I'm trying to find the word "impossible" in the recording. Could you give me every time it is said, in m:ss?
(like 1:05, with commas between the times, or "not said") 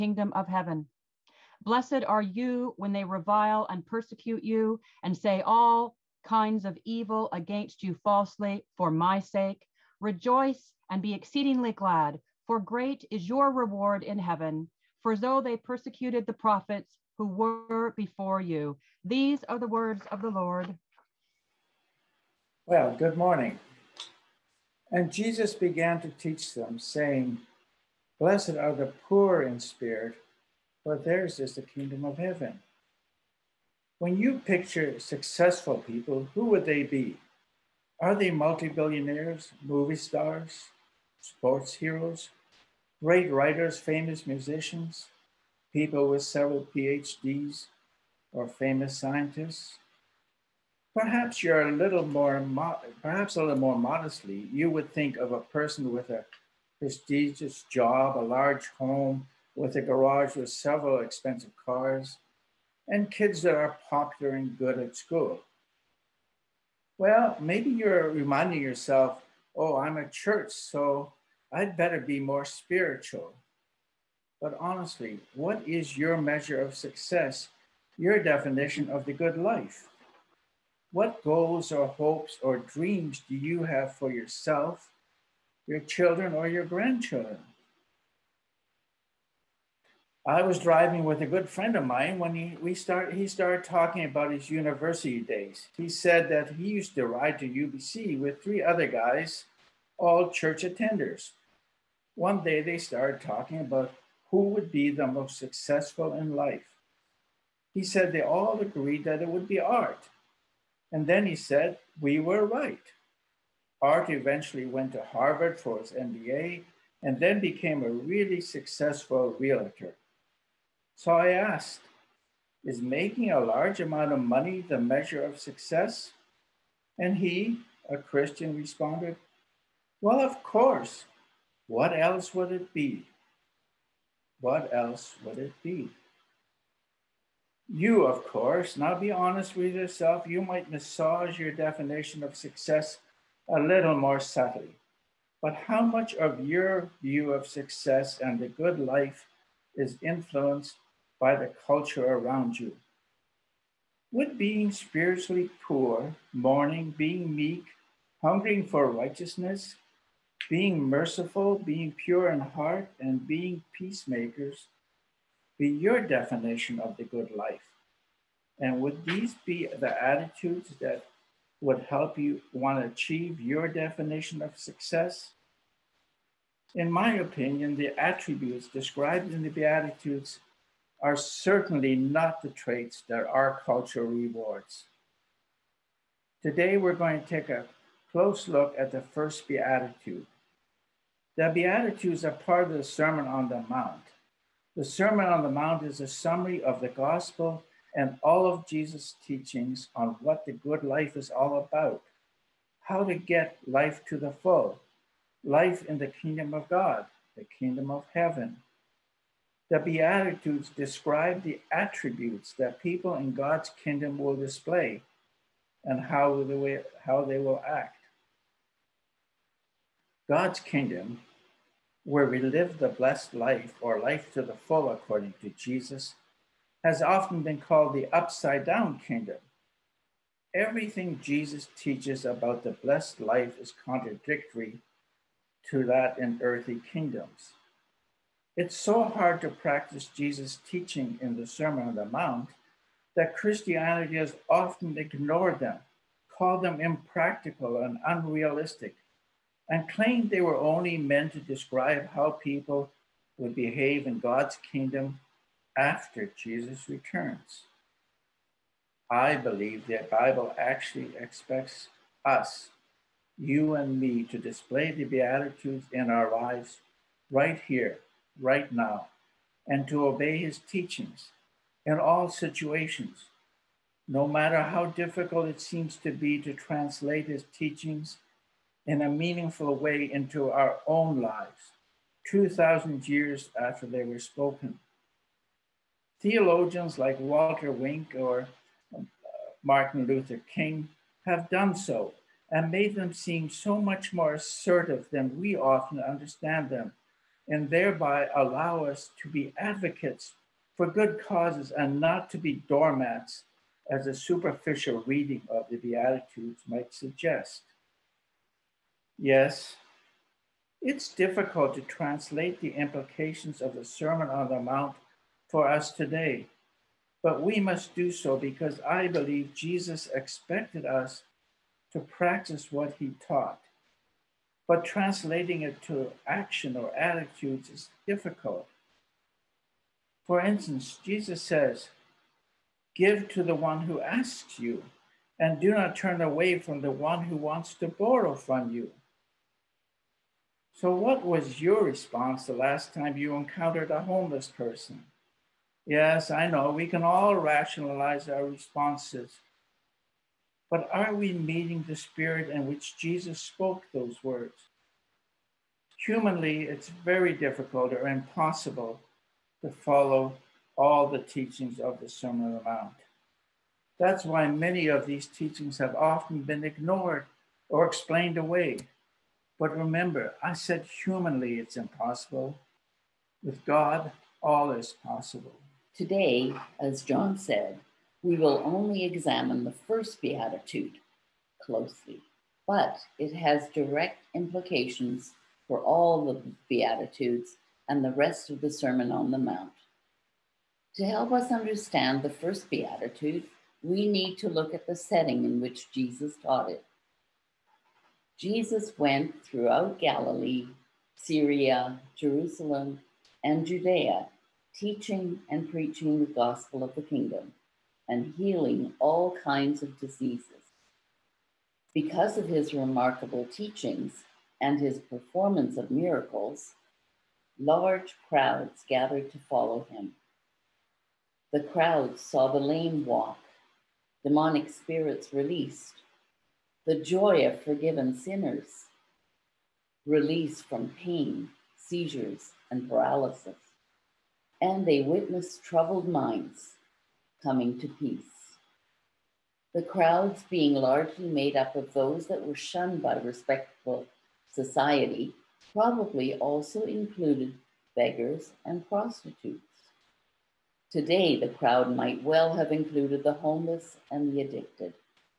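5:58, 6:11.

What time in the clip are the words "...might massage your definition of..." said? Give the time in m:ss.
2:20.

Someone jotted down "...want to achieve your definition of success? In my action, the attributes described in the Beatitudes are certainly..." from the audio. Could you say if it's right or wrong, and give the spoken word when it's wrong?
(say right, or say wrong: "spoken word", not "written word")
wrong: "opinion", not "action".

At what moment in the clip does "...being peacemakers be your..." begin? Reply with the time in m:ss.
2:43.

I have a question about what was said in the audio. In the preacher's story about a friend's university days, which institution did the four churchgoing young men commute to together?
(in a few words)
UBC.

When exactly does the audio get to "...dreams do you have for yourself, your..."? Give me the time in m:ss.
1:22.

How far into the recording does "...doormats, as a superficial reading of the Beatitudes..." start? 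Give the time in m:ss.
5:02.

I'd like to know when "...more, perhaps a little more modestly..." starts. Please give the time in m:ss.
0:52.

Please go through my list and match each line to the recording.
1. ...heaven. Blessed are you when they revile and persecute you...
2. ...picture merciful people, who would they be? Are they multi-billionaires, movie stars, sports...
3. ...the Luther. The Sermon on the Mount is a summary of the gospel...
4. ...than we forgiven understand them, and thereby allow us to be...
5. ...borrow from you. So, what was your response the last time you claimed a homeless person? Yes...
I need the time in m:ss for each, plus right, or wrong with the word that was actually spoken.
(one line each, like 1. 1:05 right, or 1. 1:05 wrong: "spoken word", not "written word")
1. 0:00 right
2. 0:34 wrong: "successful", not "merciful"
3. 3:13 wrong: "Mount", not "Luther"
4. 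4:55 wrong: "often", not "forgiven"
5. 5:37 wrong: "encountered", not "claimed".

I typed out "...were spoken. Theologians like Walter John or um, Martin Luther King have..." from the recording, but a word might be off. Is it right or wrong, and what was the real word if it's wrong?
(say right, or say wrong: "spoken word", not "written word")
wrong: "Wink", not "John".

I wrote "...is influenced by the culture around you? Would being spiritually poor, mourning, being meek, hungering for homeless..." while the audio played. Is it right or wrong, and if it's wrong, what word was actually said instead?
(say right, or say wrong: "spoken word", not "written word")
wrong: "righteousness", not "homeless".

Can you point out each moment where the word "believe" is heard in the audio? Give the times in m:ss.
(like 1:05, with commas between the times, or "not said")
4:19, 5:19.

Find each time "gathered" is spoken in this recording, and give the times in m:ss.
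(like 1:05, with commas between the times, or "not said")
6:58.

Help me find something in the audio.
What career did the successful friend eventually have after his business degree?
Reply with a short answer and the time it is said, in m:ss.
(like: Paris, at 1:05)
Realtor, at 1:59.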